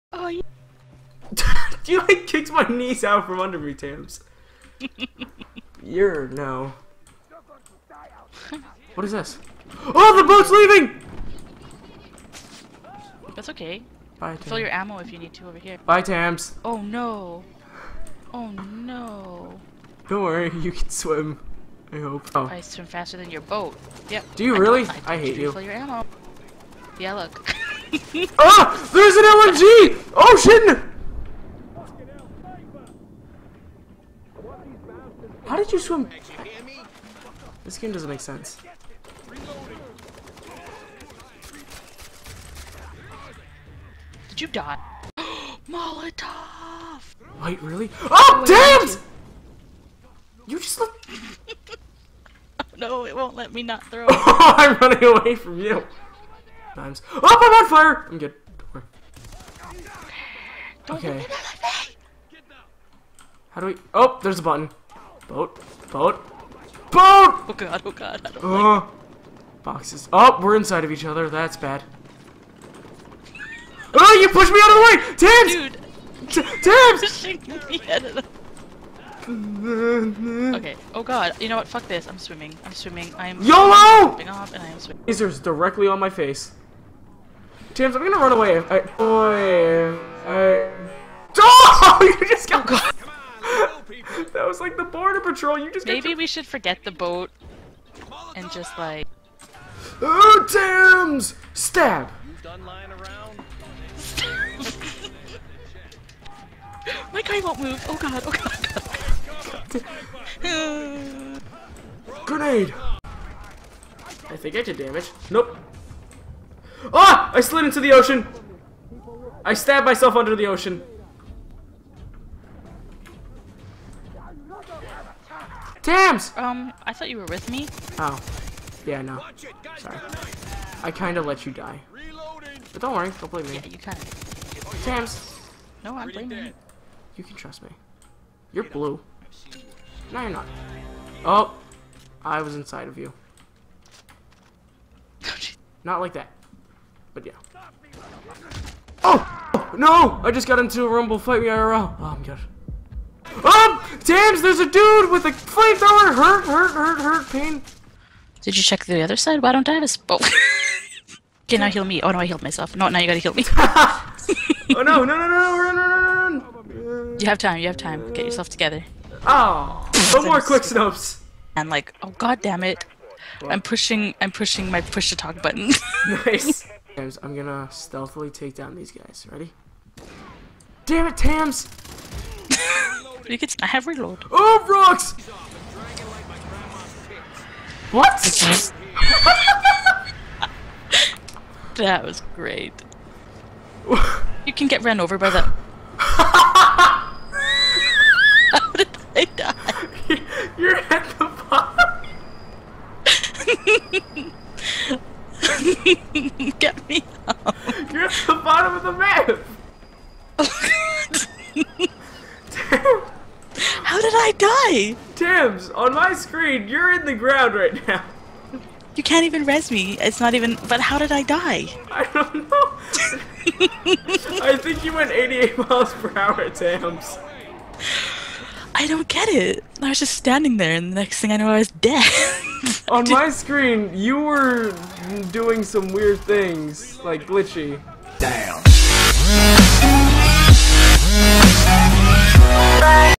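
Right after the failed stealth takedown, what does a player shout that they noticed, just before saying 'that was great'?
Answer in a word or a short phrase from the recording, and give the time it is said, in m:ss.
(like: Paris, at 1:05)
rocks, at 3:04.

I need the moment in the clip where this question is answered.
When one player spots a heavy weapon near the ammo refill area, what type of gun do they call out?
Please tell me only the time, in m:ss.
0:29.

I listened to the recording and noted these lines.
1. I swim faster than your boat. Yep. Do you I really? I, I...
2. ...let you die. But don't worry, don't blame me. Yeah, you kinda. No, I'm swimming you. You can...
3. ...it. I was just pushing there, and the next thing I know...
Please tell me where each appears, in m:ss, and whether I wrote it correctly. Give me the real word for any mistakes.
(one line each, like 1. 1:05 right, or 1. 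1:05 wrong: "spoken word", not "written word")
1. 0:22 right
2. 2:11 wrong: "blaming", not "swimming"
3. 3:49 wrong: "standing", not "pushing".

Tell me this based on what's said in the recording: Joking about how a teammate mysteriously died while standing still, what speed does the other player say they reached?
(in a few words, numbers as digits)
88 miles per hour.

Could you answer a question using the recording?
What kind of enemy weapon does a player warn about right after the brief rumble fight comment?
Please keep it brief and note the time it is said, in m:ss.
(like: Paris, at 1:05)
flamethrower, at 2:35.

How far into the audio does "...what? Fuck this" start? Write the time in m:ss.
1:21.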